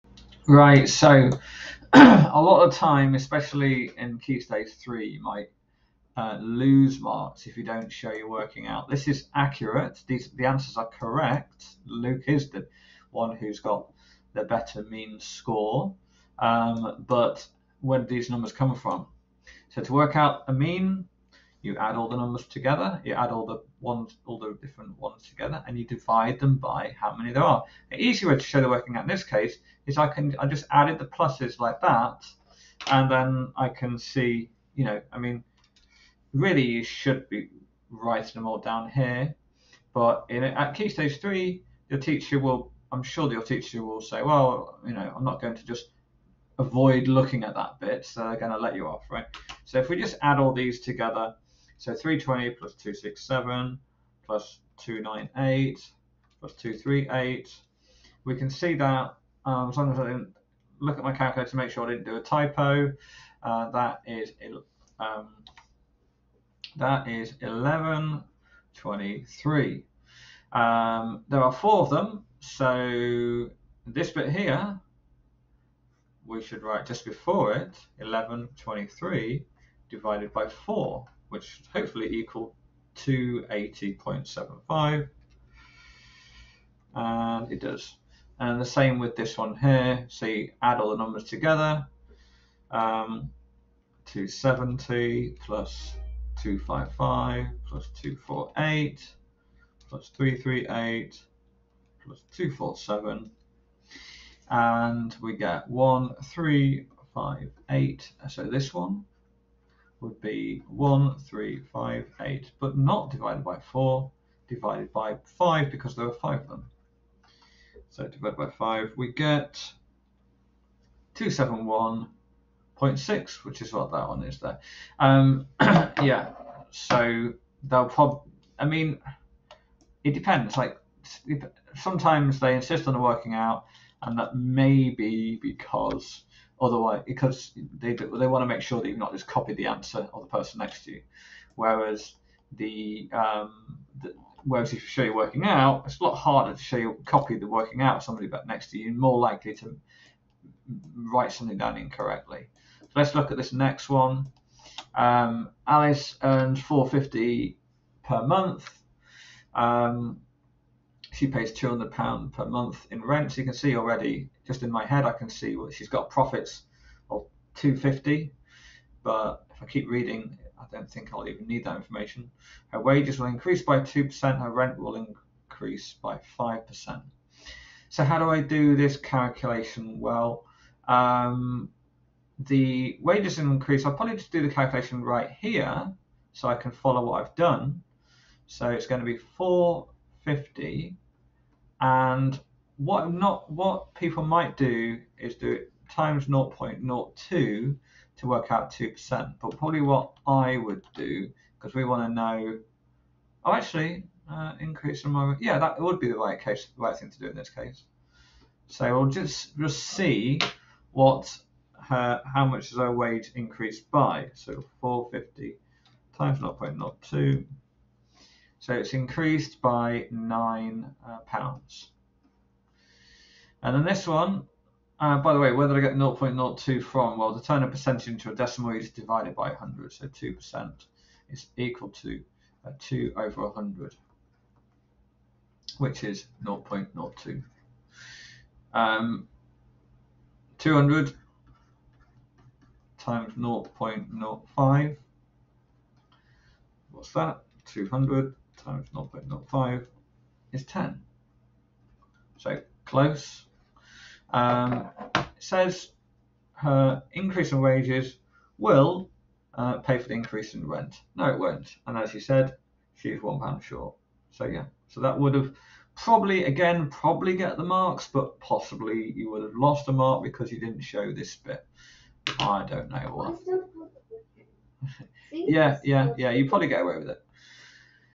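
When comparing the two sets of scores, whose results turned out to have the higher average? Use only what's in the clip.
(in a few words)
Luke.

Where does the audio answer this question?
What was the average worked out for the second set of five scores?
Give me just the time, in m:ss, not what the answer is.
2:01.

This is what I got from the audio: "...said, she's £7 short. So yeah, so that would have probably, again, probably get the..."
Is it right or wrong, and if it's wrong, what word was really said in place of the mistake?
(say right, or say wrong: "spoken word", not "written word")
wrong: "1", not "7".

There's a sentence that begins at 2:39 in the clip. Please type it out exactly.
Um, she pays two hundred pound per month in rent.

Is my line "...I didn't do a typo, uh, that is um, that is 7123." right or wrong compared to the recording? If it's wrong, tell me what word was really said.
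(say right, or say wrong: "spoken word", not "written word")
wrong: "1123", not "7123".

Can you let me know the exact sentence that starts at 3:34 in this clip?
So 450 times 0.02 so it's increased by nine uh, pounds.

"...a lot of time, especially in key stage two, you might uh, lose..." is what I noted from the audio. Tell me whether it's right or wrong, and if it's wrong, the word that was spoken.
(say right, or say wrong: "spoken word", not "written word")
wrong: "three", not "two".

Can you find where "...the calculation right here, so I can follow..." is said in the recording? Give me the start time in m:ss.
3:04.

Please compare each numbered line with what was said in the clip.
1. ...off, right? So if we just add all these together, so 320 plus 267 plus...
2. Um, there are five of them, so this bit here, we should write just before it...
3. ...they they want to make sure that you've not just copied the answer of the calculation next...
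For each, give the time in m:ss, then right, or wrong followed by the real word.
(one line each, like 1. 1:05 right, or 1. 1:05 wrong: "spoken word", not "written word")
1. 0:48 right
2. 1:10 wrong: "four", not "five"
3. 2:17 wrong: "person", not "calculation".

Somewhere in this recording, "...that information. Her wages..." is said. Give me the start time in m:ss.
2:51.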